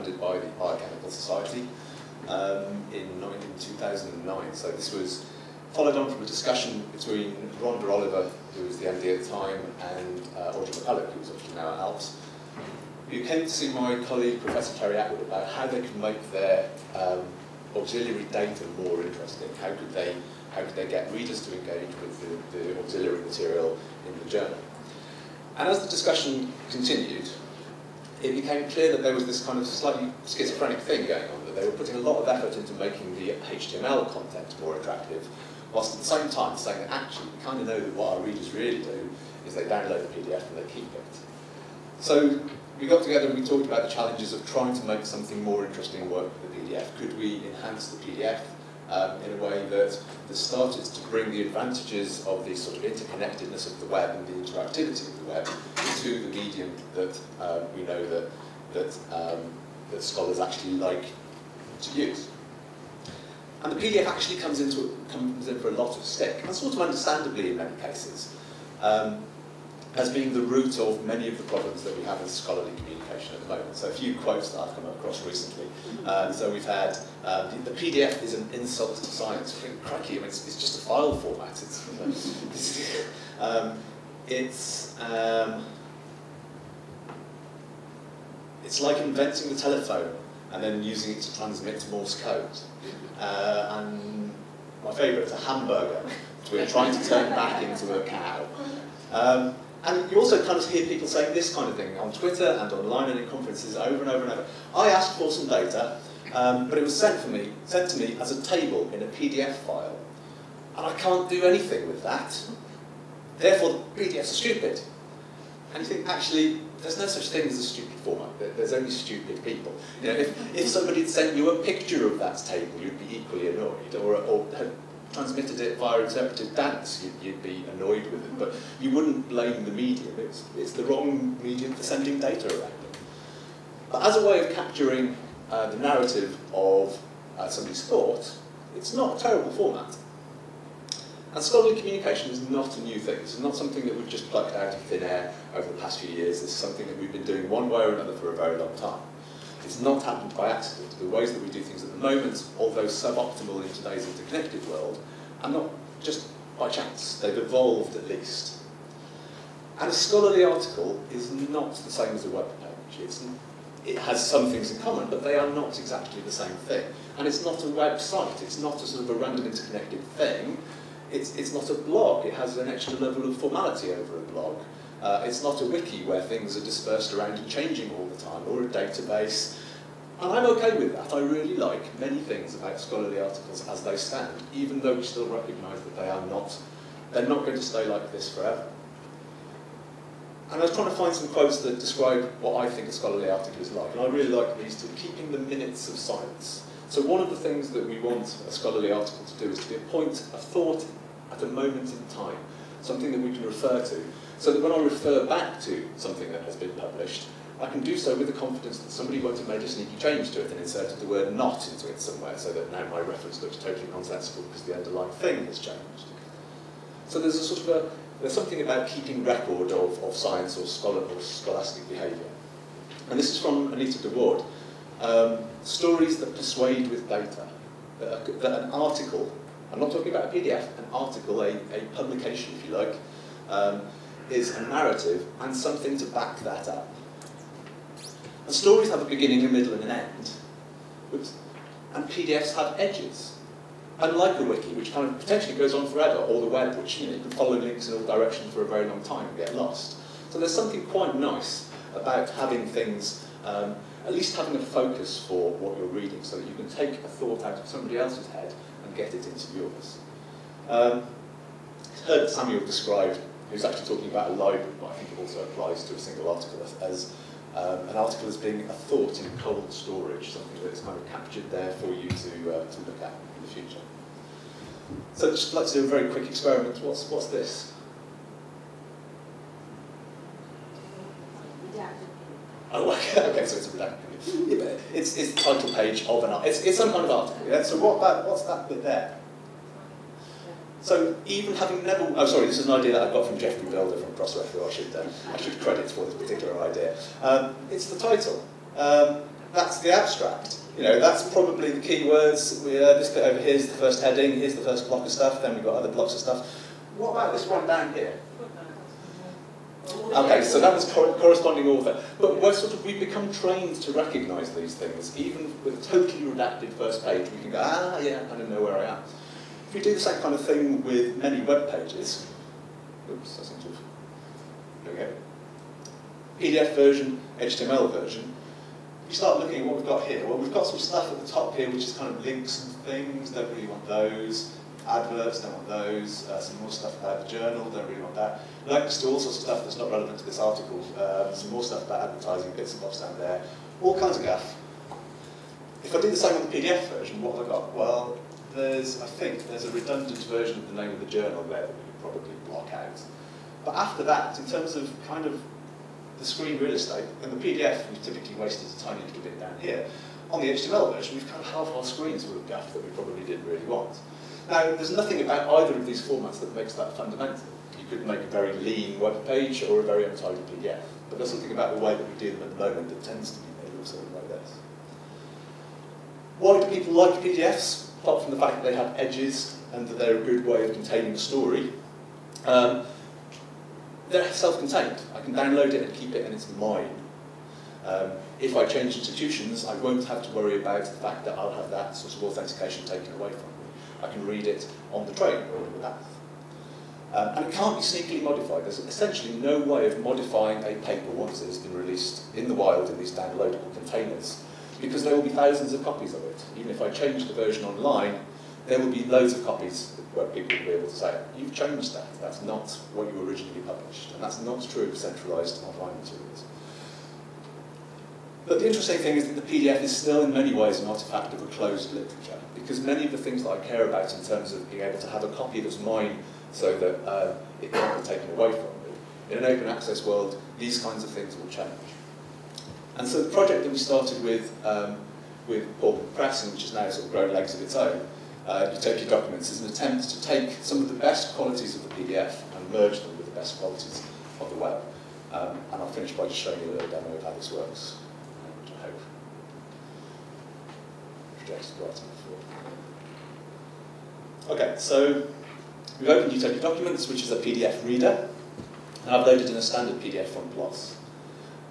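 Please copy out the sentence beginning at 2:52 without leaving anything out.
It has an extra level of formality over a blog.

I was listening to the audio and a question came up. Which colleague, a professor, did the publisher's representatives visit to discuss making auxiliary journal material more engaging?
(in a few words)
Terri Attwood.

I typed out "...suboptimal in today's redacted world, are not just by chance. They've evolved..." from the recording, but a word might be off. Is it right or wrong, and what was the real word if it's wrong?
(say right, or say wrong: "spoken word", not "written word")
wrong: "interconnected", not "redacted".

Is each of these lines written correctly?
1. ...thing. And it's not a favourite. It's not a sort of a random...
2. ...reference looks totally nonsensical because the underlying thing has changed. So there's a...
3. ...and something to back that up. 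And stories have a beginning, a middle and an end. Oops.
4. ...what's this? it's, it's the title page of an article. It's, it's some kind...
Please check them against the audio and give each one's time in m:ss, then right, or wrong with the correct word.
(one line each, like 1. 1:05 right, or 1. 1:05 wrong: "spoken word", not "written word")
1. 2:46 wrong: "website", not "favourite"
2. 3:33 right
3. 3:55 right
4. 4:37 right.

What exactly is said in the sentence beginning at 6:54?
And that's not true of centralized online materials.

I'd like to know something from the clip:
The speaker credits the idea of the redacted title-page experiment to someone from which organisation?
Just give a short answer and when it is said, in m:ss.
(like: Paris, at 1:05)
Crossref, at 4:54.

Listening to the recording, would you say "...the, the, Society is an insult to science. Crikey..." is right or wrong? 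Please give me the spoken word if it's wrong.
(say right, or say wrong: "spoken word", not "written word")
wrong: "PDF", not "Society".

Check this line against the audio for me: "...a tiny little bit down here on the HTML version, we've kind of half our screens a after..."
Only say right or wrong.
right.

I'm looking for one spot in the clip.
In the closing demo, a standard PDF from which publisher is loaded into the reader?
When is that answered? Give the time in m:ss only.
7:40.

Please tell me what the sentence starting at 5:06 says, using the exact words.
What about this one down here?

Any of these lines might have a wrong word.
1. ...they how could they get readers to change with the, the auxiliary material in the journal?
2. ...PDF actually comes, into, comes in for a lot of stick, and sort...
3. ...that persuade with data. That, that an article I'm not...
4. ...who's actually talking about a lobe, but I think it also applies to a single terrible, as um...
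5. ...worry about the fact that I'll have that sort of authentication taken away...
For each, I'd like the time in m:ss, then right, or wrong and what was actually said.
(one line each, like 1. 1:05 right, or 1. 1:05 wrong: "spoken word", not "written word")
1. 0:19 wrong: "engage", not "change"
2. 1:03 right
3. 3:46 right
4. 4:23 wrong: "article", not "terrible"
5. 6:30 right.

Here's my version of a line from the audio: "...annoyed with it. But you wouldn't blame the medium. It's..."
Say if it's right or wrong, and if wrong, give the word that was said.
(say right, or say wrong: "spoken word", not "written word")
right.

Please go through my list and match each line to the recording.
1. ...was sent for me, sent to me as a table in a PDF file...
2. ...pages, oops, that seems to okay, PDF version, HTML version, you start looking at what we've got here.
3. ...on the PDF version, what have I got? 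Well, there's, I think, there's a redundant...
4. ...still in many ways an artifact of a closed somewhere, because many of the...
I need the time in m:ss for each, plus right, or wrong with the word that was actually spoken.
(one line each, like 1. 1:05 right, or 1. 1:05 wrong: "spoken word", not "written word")
1. 1:46 right
2. 5:21 right
3. 5:46 right
4. 6:59 wrong: "literature", not "somewhere".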